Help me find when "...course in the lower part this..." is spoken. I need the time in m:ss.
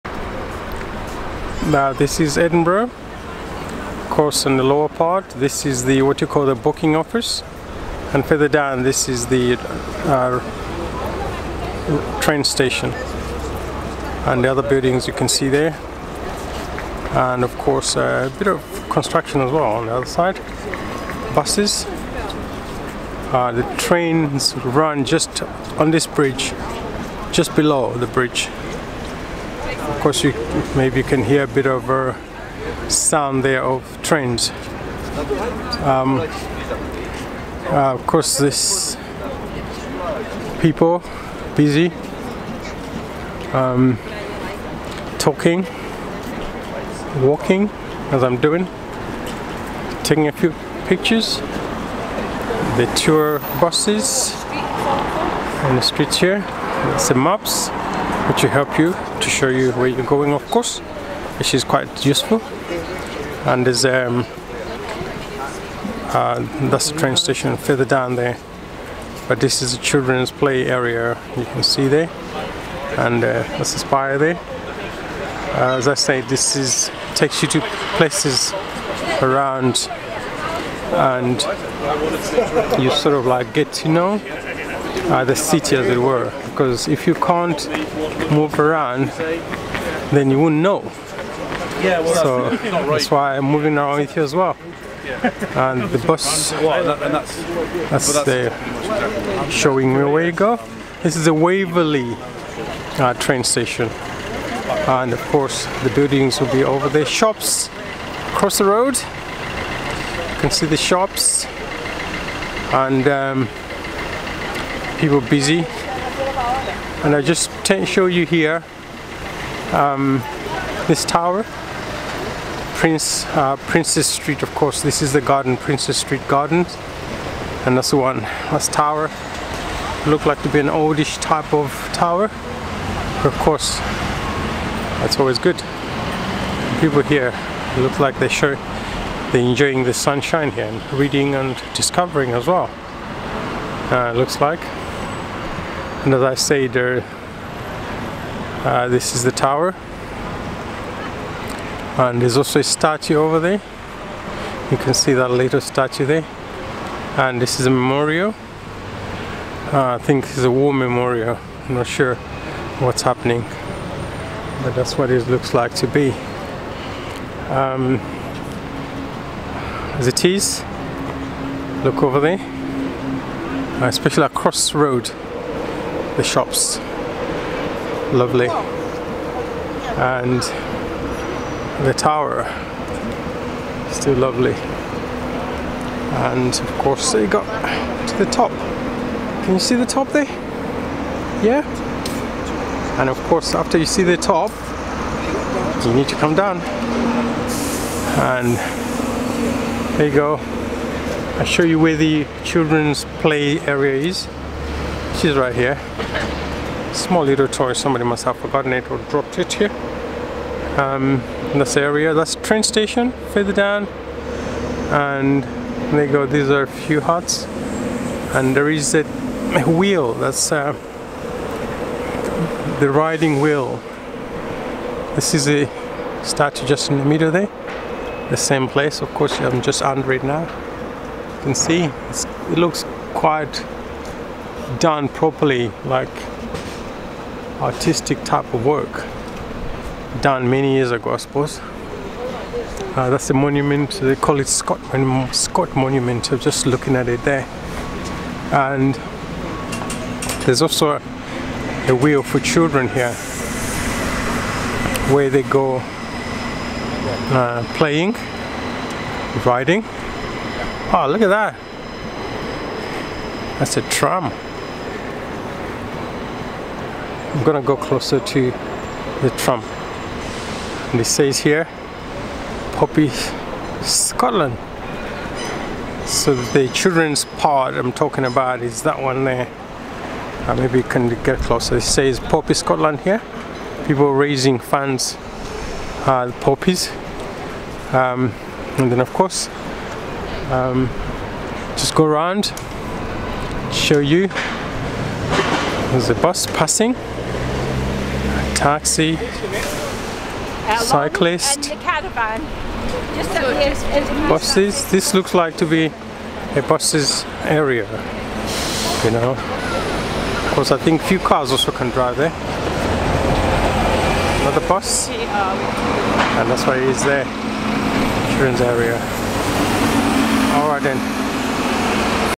0:04.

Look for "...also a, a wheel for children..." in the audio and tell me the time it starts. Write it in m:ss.
4:10.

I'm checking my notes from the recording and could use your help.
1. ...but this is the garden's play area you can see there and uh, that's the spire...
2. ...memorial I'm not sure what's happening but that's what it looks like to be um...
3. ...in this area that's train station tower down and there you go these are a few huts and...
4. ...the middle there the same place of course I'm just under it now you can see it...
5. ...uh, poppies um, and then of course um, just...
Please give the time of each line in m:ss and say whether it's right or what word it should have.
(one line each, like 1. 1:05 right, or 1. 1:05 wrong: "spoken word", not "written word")
1. 1:09 wrong: "children", not "garden"
2. 2:40 right
3. 3:31 wrong: "further", not "tower"
4. 3:46 right
5. 4:46 right.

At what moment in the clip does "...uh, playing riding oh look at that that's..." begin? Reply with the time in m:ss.
4:17.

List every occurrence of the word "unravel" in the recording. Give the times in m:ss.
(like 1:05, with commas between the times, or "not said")
not said.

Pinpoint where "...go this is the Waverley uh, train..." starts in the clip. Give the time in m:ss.
1:40.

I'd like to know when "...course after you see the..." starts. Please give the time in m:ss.
3:13.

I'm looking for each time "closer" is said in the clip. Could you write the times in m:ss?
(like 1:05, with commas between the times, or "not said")
4:27, 4:41.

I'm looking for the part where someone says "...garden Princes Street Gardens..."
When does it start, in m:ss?
2:05.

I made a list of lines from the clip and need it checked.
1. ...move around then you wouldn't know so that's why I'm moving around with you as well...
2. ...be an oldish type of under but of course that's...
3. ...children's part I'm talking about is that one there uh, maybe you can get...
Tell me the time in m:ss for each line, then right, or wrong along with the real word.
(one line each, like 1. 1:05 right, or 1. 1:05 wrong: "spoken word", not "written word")
1. 1:28 right
2. 2:10 wrong: "tower", not "under"
3. 4:36 right.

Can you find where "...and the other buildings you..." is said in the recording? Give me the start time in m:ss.
0:14.